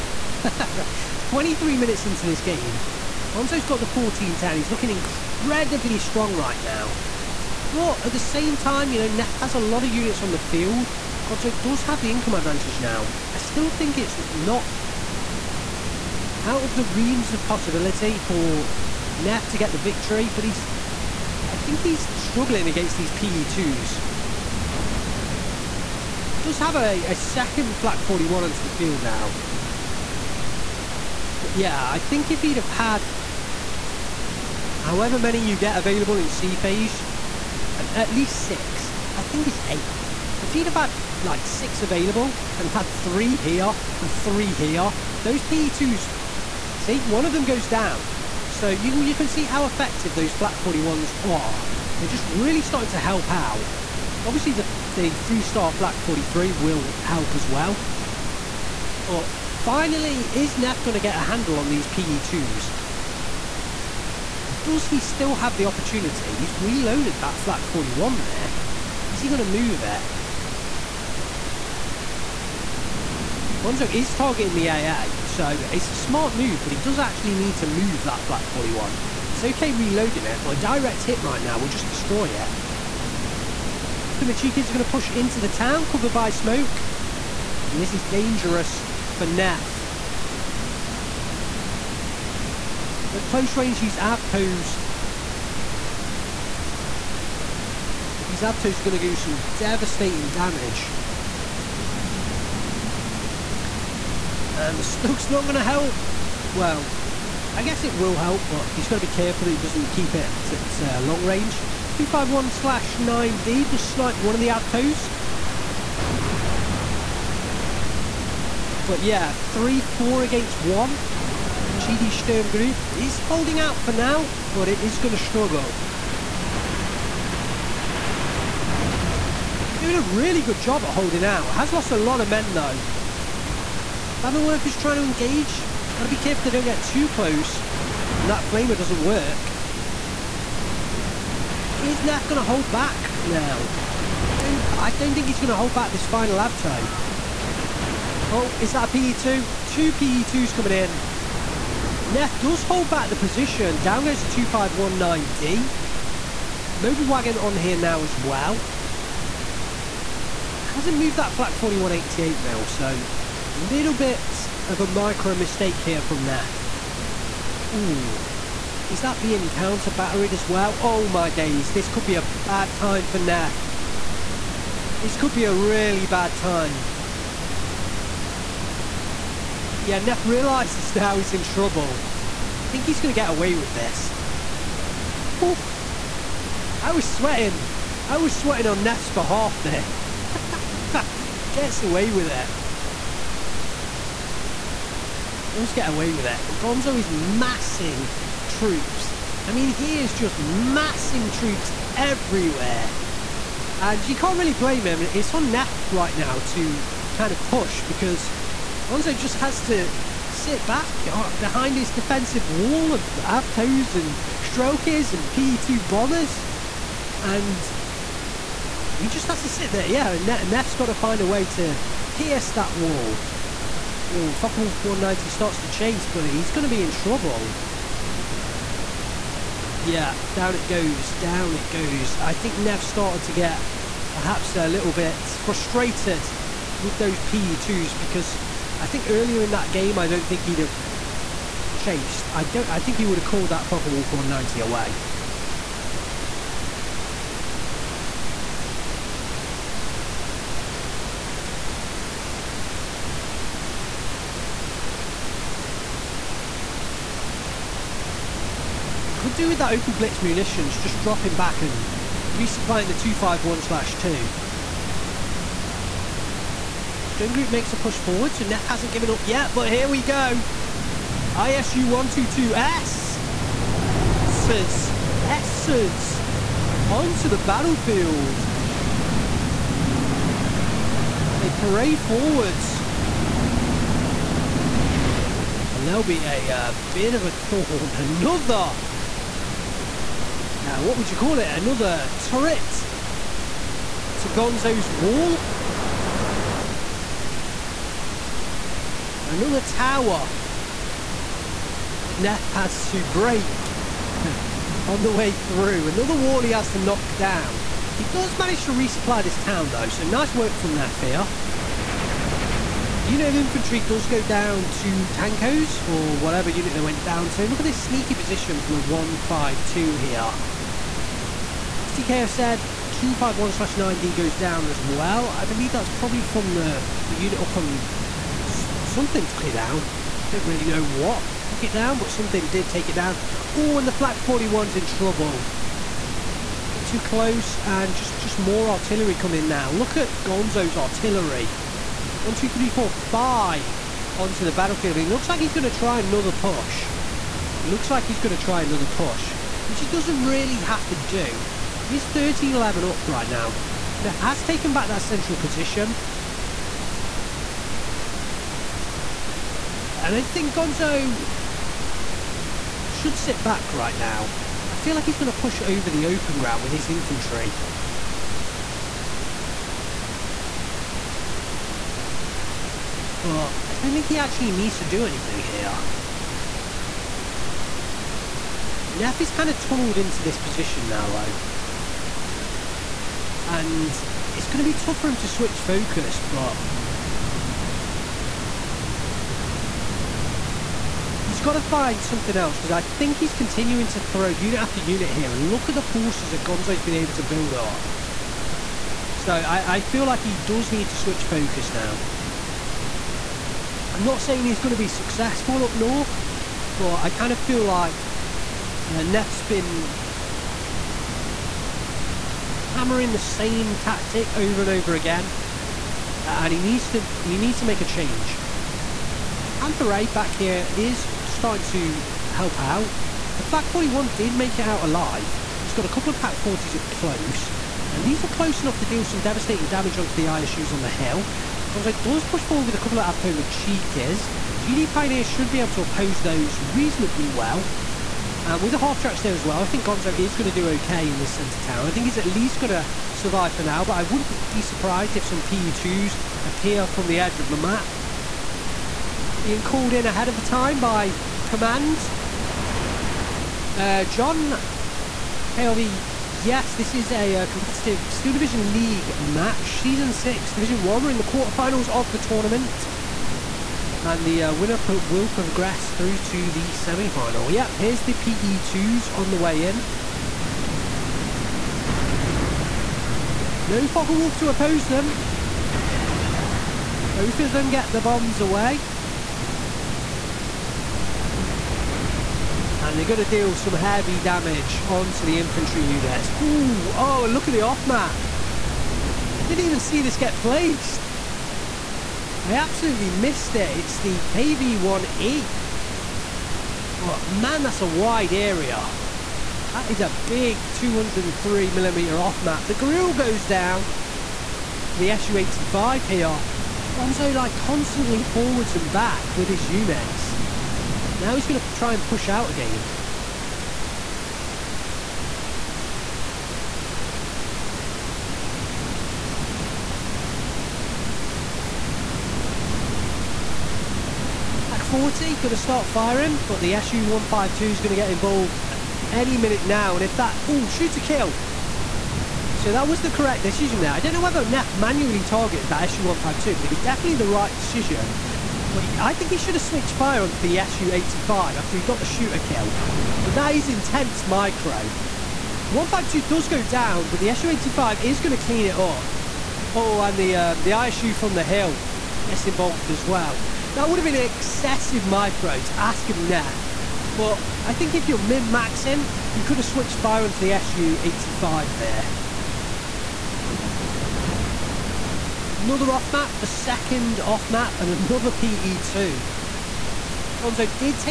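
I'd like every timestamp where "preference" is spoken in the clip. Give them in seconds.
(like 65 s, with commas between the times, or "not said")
not said.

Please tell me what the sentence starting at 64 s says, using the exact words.
Does he still have the opportunity?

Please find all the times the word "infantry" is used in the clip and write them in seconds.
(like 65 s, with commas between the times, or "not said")
313 s, 366 s, 485 s.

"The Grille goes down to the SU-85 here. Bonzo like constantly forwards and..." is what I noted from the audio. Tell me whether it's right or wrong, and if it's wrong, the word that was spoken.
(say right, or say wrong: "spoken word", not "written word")
right.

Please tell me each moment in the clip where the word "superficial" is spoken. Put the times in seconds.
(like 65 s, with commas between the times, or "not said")
not said.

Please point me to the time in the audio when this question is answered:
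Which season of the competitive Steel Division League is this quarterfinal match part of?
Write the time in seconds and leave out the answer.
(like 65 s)
459 s.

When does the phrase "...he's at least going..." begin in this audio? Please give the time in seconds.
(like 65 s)
442 s.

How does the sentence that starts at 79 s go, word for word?
It's okay reloading it, but a direct hit right now will just destroy it.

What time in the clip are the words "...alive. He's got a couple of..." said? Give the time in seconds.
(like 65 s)
424 s.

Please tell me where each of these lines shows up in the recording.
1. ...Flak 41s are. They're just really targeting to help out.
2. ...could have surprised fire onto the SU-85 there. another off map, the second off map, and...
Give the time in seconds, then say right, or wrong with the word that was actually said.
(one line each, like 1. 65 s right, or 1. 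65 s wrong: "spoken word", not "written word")
1. 50 s wrong: "starting", not "targeting"
2. 559 s wrong: "switched", not "surprised".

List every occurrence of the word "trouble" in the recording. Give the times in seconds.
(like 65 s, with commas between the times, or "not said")
181 s, 226 s, 334 s.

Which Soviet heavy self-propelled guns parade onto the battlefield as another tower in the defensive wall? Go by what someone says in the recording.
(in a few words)
ISU-122S.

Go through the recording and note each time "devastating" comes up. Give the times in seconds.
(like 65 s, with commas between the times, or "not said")
99 s, 429 s.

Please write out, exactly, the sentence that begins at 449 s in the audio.
Being called in ahead of the time by command.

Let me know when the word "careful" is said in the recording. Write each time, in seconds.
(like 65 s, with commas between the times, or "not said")
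109 s, 136 s.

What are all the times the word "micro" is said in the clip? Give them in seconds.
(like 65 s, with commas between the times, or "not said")
164 s, 544 s, 555 s.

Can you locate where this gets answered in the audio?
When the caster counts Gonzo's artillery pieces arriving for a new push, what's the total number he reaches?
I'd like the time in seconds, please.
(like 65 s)
343 s.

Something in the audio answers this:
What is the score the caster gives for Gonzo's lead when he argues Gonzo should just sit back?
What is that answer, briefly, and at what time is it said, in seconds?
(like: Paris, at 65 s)
13-11, at 352 s.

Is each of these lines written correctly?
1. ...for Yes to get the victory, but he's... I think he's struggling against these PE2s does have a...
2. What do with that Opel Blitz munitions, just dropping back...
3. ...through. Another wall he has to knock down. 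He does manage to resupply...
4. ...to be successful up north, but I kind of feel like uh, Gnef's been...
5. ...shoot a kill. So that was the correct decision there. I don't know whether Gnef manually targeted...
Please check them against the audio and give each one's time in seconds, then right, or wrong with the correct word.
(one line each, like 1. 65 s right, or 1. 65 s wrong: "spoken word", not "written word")
1. 18 s wrong: "Neff", not "Yes"
2. 259 s right
3. 305 s right
4. 404 s right
5. 530 s right.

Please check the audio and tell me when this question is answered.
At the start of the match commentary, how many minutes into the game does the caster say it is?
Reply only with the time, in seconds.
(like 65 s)
1 s.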